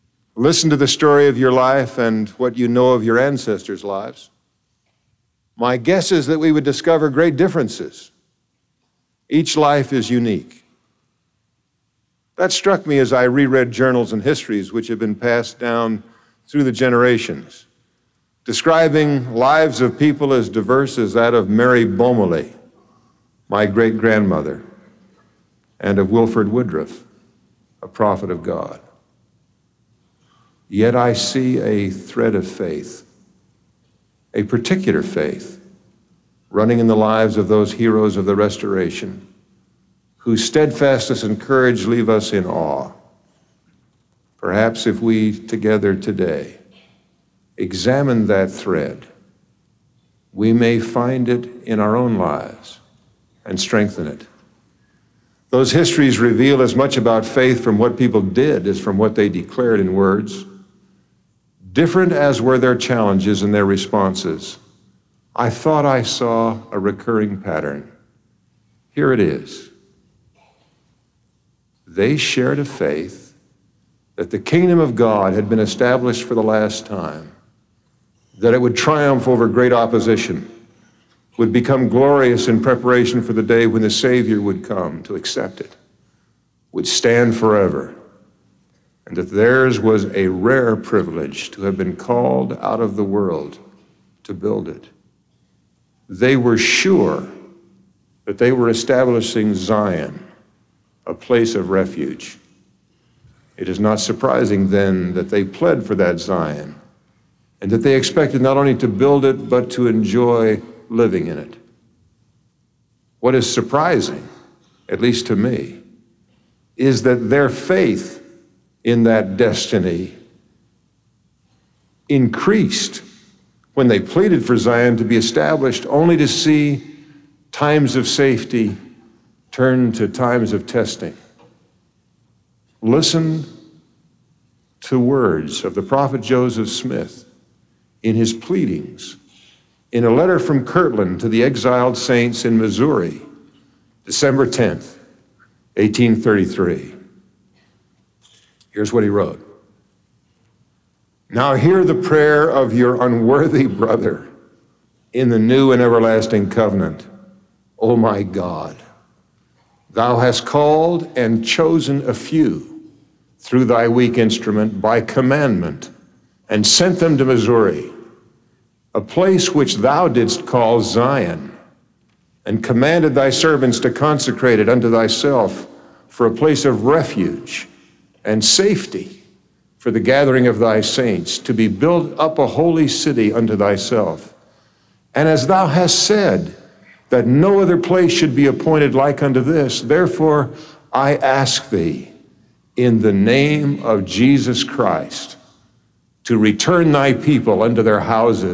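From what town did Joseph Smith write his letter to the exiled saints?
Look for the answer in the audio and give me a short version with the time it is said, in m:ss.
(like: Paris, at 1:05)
Kirtland, at 2:20.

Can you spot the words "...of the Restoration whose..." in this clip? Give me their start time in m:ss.
0:38.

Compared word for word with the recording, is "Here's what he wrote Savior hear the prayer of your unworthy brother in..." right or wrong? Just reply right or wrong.
wrong.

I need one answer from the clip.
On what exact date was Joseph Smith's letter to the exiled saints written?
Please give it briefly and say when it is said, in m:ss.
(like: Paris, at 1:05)
December 10, 1833, at 2:24.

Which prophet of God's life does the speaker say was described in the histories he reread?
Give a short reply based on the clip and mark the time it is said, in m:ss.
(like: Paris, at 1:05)
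Wilford Woodruff, at 0:26.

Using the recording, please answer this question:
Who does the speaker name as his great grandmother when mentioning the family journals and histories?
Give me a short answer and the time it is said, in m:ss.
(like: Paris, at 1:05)
Mary Bommeli, at 0:21.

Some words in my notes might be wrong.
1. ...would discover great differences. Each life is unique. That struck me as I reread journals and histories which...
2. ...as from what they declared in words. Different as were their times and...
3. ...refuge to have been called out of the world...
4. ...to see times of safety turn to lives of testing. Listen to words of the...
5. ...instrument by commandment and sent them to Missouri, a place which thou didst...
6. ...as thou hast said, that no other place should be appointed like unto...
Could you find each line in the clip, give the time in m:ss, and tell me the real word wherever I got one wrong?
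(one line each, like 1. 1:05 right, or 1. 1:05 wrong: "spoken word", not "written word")
1. 0:06 right
2. 0:58 wrong: "challenges", not "times"
3. 1:30 wrong: "privilege", not "refuge"
4. 2:06 wrong: "times", not "lives"
5. 2:44 right
6. 3:05 right.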